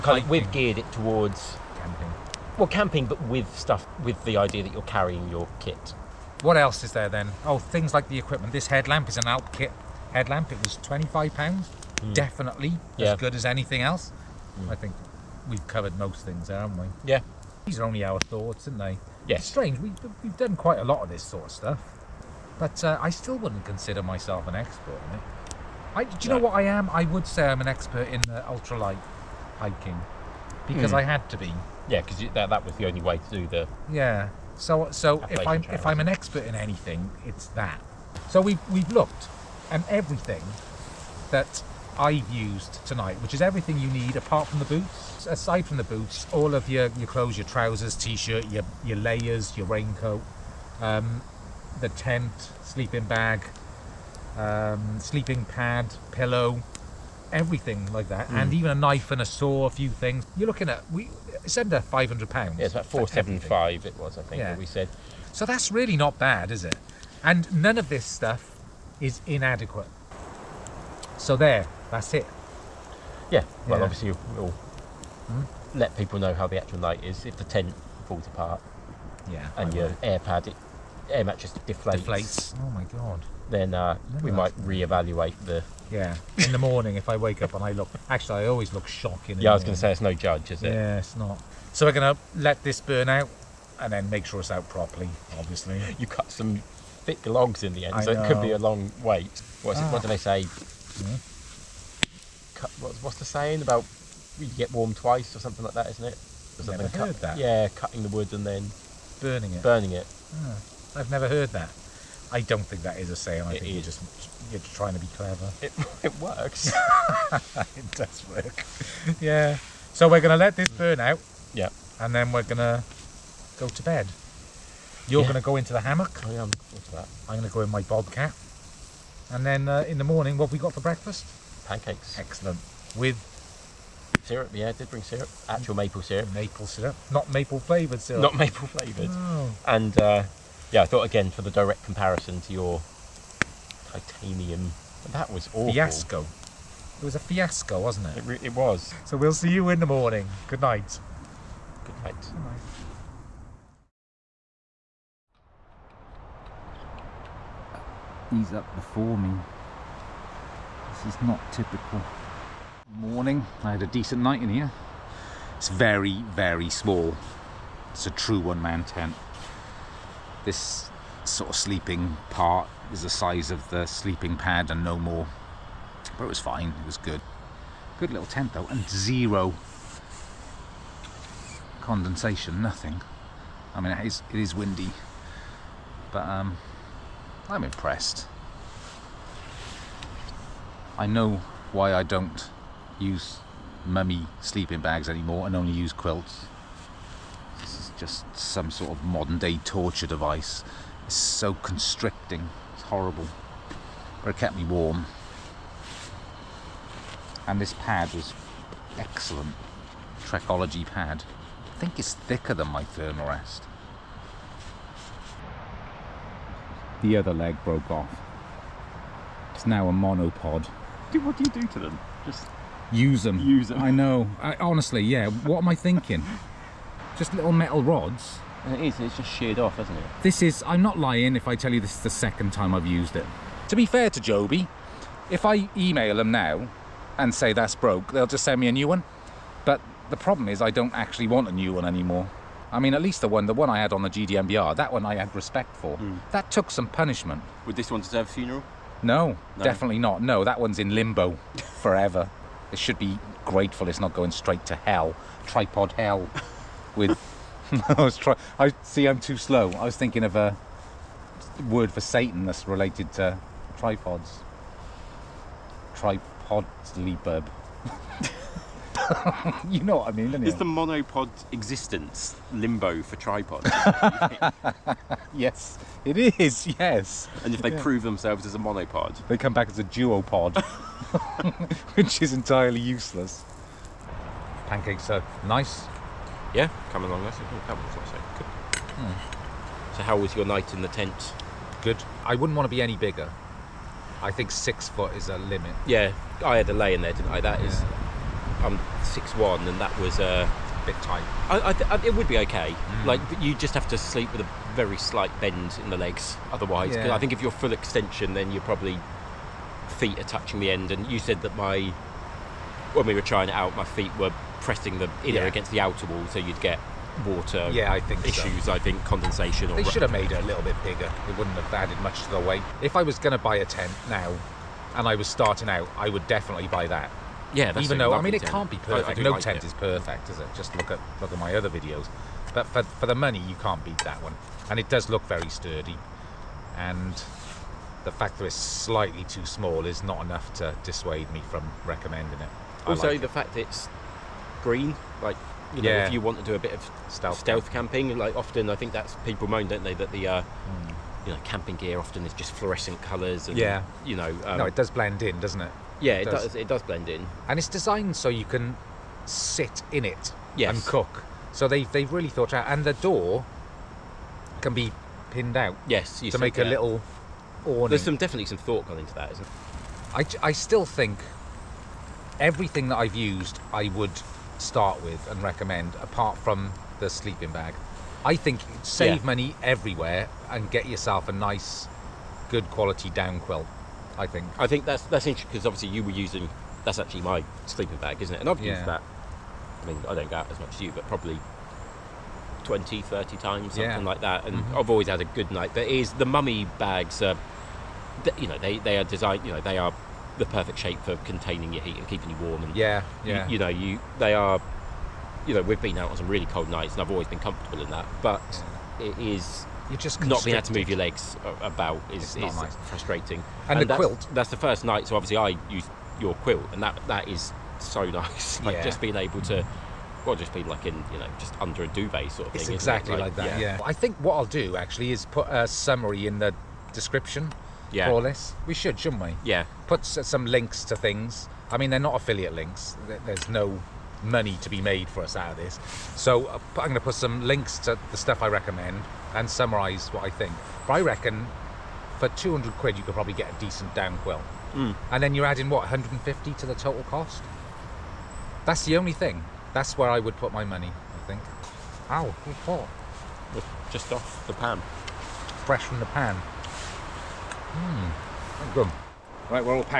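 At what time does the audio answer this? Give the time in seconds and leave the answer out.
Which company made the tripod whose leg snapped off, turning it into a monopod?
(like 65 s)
234 s.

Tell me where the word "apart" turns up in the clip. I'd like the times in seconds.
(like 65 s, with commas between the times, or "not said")
44 s, 78 s, 376 s.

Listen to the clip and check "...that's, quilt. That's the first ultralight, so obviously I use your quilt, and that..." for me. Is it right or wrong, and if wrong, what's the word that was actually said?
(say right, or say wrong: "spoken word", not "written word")
wrong: "night", not "ultralight".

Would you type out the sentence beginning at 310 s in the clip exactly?
And you said that my when we were trying it out, my feet were pressing them either yeah.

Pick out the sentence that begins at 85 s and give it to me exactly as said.
Yeah, in the morning if I wake up and I look, actually I always look shocking.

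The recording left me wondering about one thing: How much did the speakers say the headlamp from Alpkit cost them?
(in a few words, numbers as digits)
£25.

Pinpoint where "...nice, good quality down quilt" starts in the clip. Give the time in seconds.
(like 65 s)
381 s.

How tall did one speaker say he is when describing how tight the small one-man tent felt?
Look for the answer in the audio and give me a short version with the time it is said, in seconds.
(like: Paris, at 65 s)
6 foot 1, at 299 s.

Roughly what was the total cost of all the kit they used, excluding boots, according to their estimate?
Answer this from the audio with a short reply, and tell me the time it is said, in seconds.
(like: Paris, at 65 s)
£475, at 62 s.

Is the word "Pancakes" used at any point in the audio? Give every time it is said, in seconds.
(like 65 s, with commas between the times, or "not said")
131 s, 284 s.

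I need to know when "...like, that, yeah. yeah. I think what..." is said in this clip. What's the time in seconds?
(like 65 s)
423 s.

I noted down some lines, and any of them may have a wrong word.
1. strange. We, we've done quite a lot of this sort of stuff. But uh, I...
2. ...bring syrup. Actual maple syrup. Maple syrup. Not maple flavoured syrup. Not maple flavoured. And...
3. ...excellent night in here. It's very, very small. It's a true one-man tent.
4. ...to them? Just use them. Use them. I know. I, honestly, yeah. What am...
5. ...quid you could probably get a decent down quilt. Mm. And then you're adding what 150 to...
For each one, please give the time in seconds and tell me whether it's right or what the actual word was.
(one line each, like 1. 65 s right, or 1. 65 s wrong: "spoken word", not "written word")
1. 19 s right
2. 134 s right
3. 163 s wrong: "decent", not "excellent"
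4. 221 s right
5. 442 s right.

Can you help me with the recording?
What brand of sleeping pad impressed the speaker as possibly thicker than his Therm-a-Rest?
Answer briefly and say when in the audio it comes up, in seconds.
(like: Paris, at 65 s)
Trekology, at 210 s.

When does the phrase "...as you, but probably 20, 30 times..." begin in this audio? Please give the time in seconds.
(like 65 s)
390 s.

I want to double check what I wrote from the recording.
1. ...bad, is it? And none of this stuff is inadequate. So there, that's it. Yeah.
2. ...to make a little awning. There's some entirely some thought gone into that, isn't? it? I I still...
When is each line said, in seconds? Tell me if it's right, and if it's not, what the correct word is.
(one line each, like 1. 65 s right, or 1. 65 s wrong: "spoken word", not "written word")
1. 66 s right
2. 366 s wrong: "definitely", not "entirely".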